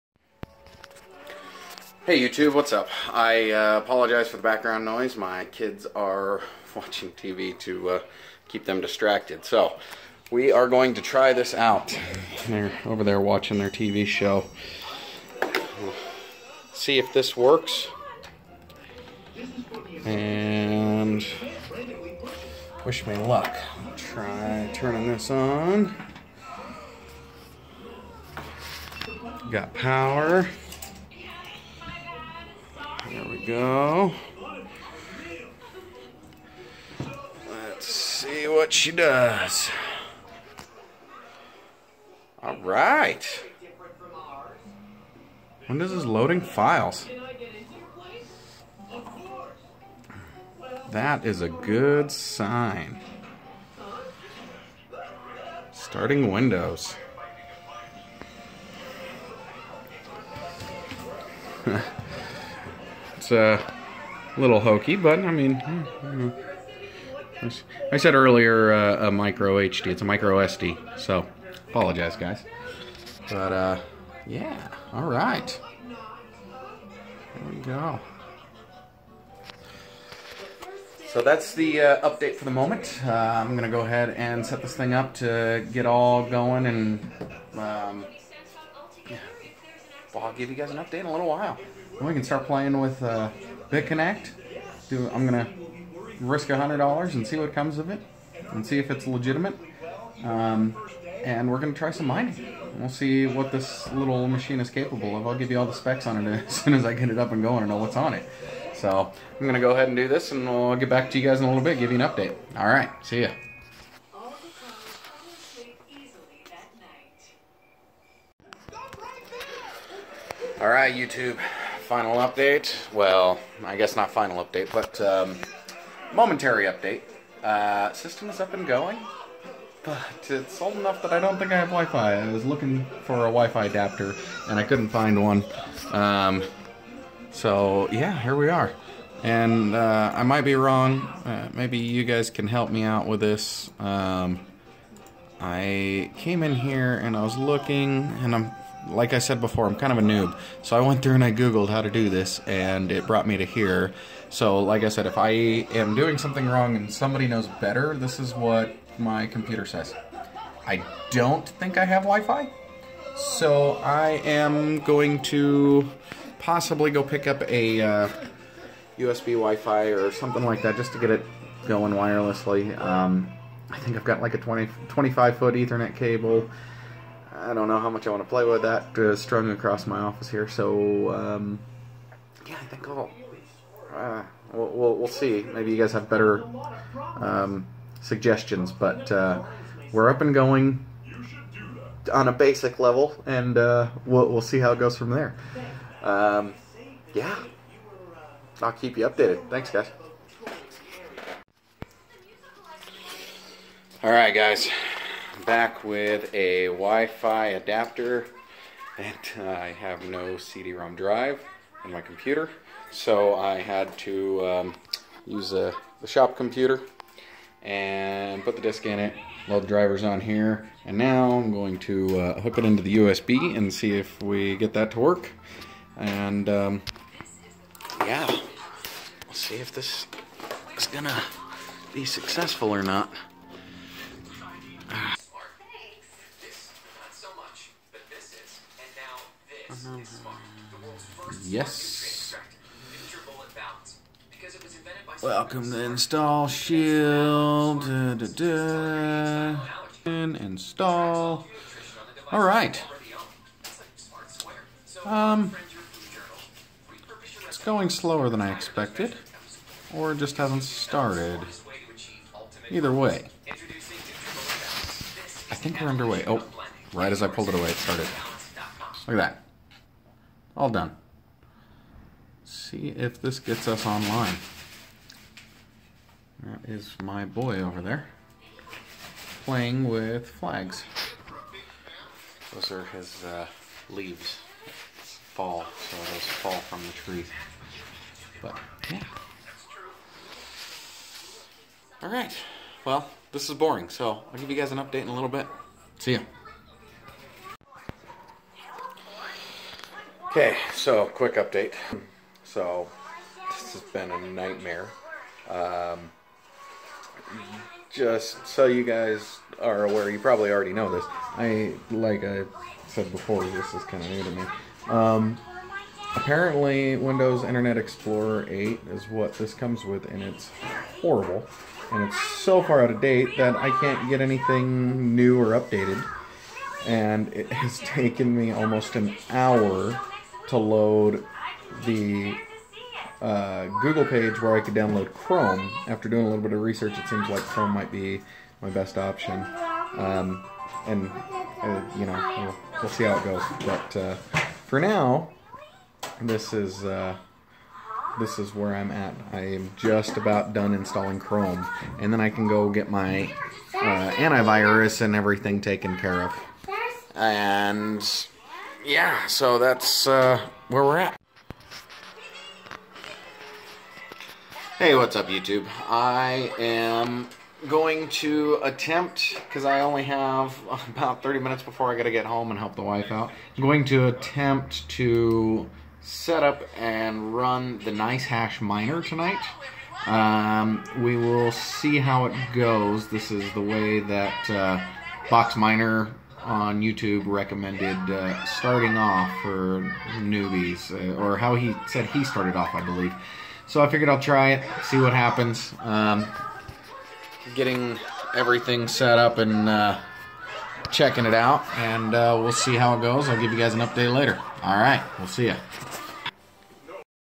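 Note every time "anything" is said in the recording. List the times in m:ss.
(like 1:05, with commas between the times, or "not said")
5:24.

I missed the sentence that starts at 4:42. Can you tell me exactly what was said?
Those are his uh, leaves fall, so those fall from the trees.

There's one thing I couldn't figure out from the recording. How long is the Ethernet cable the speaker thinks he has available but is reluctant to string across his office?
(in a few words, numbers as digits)
20 to 25 feet.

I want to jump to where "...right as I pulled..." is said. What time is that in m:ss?
4:26.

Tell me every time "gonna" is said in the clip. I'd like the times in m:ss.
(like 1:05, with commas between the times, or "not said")
1:35, 1:41, 1:49, 3:50.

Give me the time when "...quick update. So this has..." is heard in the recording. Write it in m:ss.
5:01.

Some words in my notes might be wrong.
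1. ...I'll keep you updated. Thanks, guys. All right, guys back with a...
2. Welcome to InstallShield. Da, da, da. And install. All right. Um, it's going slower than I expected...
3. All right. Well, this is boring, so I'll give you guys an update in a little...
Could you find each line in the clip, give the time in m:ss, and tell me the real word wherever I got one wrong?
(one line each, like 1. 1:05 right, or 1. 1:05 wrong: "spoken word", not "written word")
1. 3:18 right
2. 4:05 right
3. 4:52 right.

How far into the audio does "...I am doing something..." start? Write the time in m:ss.
2:35.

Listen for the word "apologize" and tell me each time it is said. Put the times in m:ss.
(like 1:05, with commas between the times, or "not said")
0:03, 1:11.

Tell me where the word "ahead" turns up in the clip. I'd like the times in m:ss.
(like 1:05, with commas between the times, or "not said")
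1:23, 1:49.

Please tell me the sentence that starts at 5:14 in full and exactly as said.
Um, apparently, Windows Internet Explorer 8 is what this comes with, and it's horrible.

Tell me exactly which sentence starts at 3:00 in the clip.
So um, yeah, I think I'll.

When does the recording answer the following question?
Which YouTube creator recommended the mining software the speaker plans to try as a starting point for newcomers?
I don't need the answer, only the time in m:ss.
6:25.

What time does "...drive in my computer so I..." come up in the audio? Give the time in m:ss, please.
3:30.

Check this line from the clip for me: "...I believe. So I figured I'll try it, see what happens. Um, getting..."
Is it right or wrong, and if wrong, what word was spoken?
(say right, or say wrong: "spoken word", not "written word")
right.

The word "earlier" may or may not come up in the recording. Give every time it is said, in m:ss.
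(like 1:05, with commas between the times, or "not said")
1:08.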